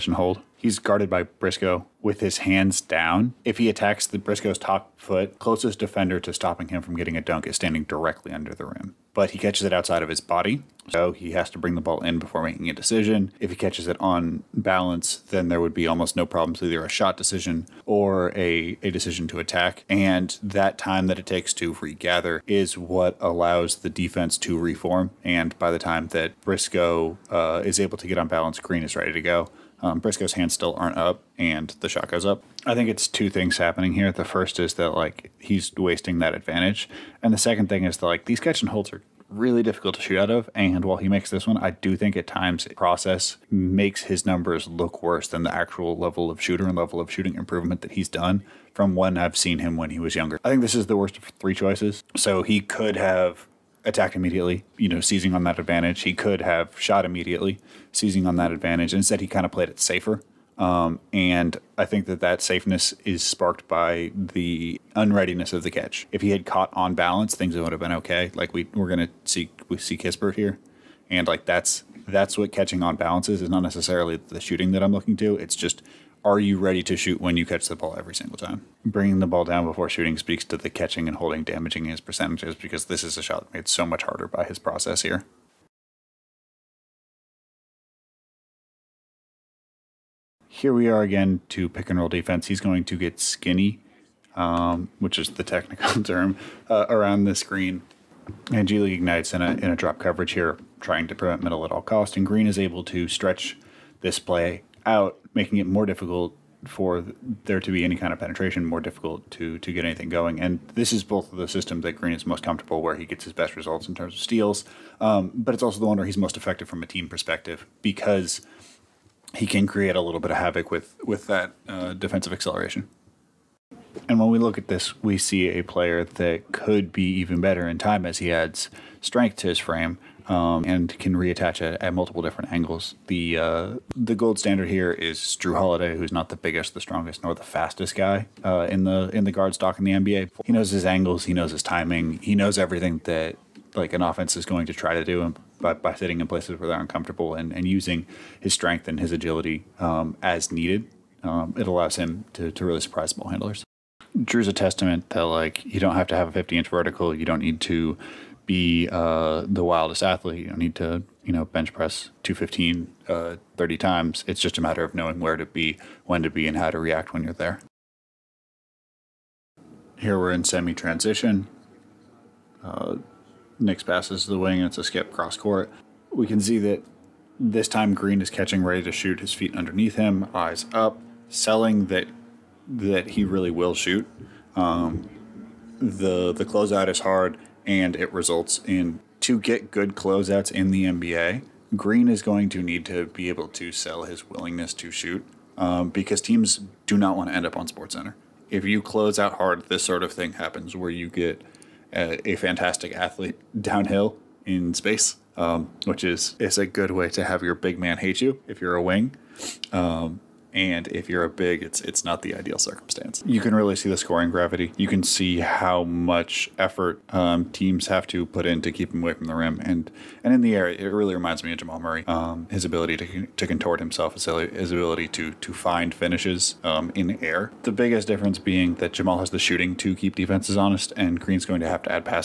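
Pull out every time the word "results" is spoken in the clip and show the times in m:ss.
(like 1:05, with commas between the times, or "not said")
1:53, 3:08.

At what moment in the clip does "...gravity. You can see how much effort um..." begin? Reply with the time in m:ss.
3:34.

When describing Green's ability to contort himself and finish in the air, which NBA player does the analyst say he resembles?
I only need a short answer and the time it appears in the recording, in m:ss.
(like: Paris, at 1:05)
Jamal Murray, at 3:41.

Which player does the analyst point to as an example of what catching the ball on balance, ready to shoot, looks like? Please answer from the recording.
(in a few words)
Kispert.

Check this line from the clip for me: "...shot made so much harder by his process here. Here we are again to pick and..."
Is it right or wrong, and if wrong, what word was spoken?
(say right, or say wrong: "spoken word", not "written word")
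right.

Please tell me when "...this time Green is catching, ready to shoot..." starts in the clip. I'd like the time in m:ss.
2:57.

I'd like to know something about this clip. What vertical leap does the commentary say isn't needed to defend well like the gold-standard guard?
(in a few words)
50 inches.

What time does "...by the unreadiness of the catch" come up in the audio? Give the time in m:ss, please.
1:03.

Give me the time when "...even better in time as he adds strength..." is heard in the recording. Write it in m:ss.
2:07.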